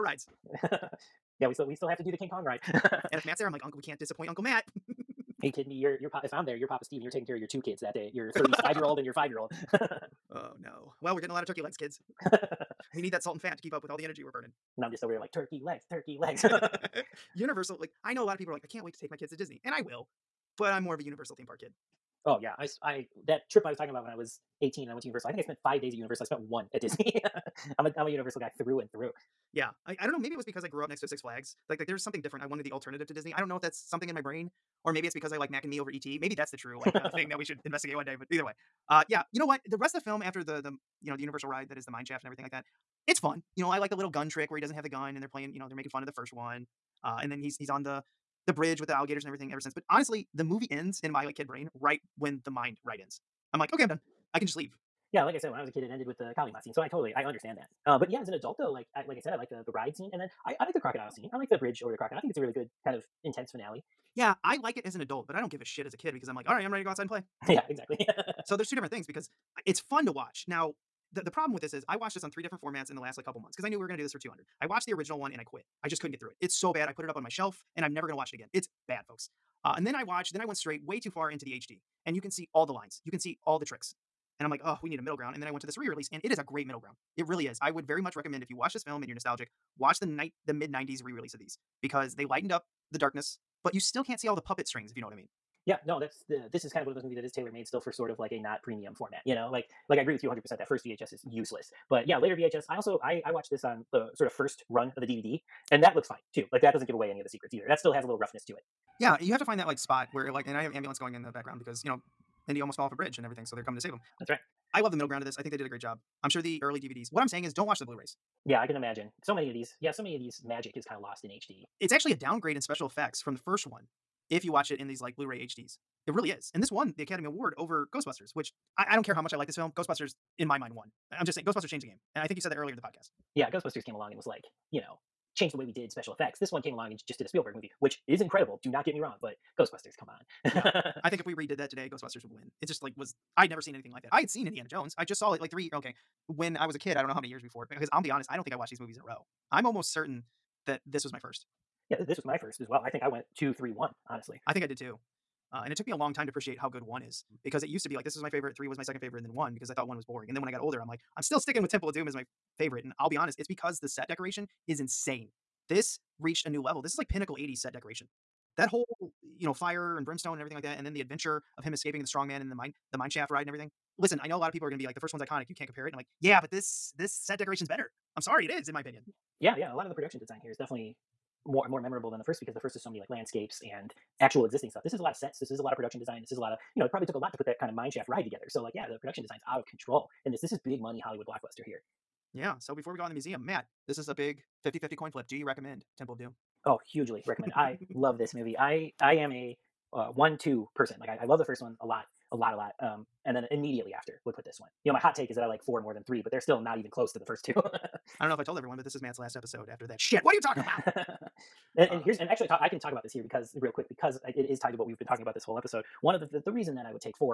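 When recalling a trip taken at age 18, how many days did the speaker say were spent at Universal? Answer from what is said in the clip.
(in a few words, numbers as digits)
5.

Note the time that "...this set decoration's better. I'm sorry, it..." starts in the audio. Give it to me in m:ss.
2:56.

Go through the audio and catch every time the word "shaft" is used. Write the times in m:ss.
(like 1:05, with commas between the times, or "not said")
0:42, 2:53, 3:07.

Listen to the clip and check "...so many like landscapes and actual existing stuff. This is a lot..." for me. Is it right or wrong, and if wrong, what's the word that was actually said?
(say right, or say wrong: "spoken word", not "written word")
right.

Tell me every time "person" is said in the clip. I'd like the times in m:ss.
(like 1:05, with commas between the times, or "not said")
3:20.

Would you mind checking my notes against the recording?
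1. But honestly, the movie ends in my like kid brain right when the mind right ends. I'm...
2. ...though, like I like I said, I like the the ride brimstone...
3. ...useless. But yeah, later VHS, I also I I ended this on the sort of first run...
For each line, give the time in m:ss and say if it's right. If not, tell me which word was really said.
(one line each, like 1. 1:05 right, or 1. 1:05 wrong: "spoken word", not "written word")
1. 0:49 right
2. 0:58 wrong: "scene", not "brimstone"
3. 1:41 wrong: "watched", not "ended".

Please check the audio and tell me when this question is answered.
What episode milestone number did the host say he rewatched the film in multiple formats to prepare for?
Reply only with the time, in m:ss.
1:14.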